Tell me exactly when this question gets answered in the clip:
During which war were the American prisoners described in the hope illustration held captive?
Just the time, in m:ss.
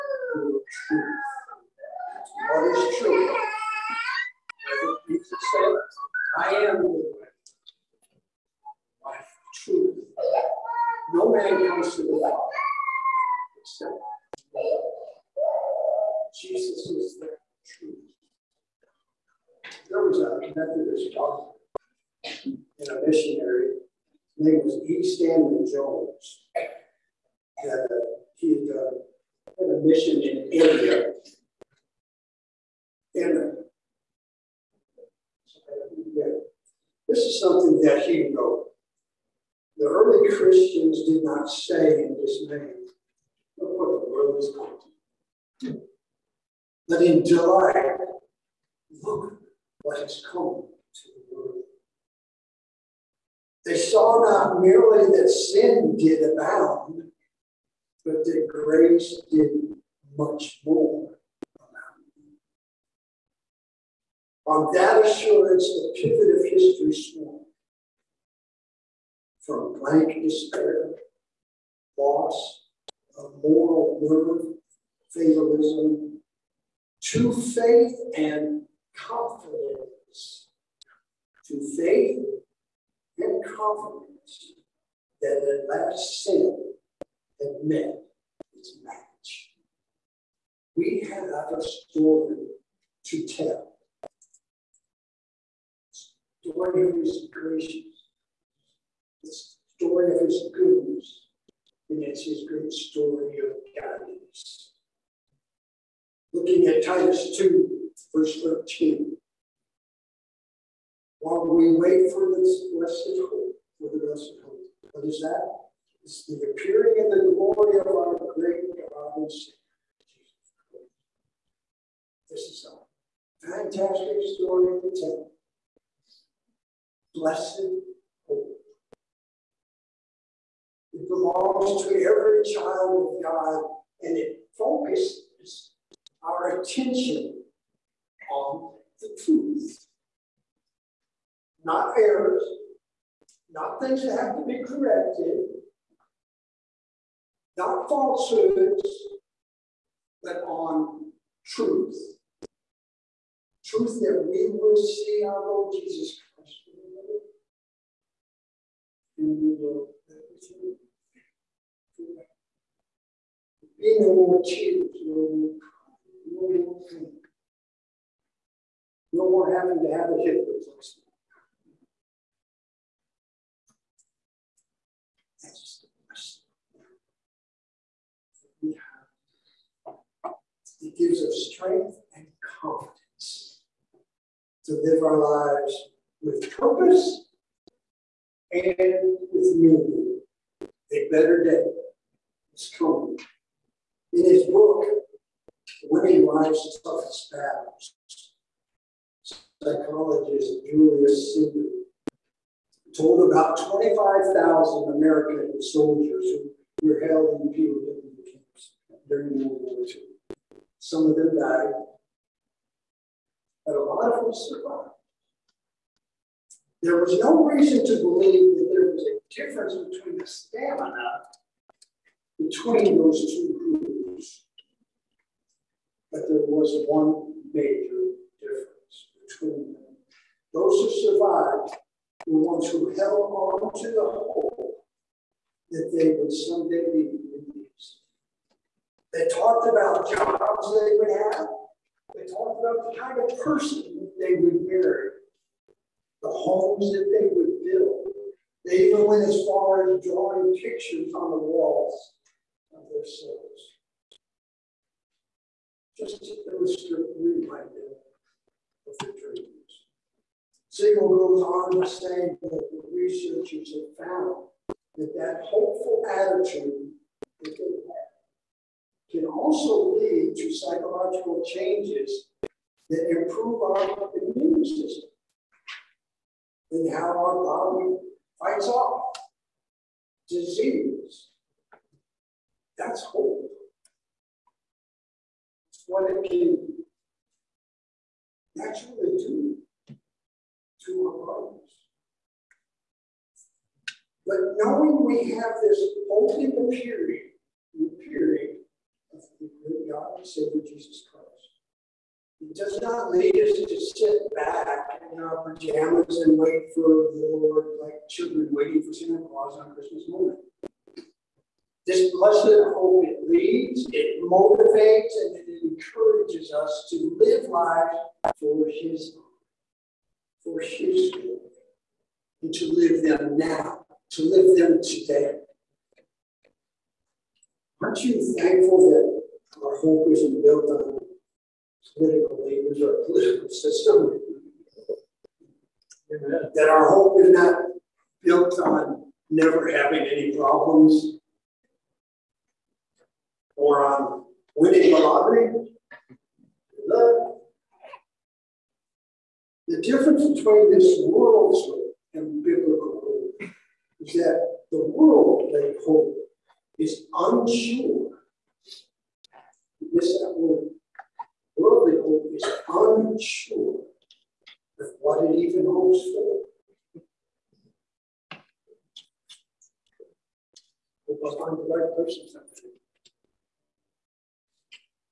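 3:29.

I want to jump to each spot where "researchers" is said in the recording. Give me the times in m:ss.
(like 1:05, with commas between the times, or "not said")
4:22.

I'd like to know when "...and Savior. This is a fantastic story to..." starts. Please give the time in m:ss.
1:59.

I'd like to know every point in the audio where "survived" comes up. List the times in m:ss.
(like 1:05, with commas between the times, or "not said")
3:34, 3:51.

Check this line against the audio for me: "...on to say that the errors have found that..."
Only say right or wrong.
wrong.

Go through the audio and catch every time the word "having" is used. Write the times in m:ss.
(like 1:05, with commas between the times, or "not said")
2:49, 5:39.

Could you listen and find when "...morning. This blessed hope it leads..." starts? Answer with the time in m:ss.
5:10.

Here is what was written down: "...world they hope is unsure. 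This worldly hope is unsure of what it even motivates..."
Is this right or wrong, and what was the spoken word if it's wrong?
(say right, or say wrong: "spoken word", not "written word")
wrong: "hopes", not "motivates".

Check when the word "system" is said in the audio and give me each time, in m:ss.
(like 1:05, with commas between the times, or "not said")
4:34, 5:33.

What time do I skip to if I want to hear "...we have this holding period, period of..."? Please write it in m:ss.
4:55.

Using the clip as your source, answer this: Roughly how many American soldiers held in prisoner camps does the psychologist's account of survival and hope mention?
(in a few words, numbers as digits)
25,000.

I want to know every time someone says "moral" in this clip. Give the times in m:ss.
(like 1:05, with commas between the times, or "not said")
1:13.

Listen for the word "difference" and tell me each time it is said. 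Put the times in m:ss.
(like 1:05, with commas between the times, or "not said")
3:39, 3:48, 5:49.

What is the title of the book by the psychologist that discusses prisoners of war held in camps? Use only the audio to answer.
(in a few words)
Winning Life's Toughest Battles.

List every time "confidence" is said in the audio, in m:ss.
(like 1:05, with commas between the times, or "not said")
1:18, 1:23, 3:02.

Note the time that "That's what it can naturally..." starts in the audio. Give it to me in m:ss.
4:45.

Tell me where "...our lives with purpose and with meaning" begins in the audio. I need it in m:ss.
3:05.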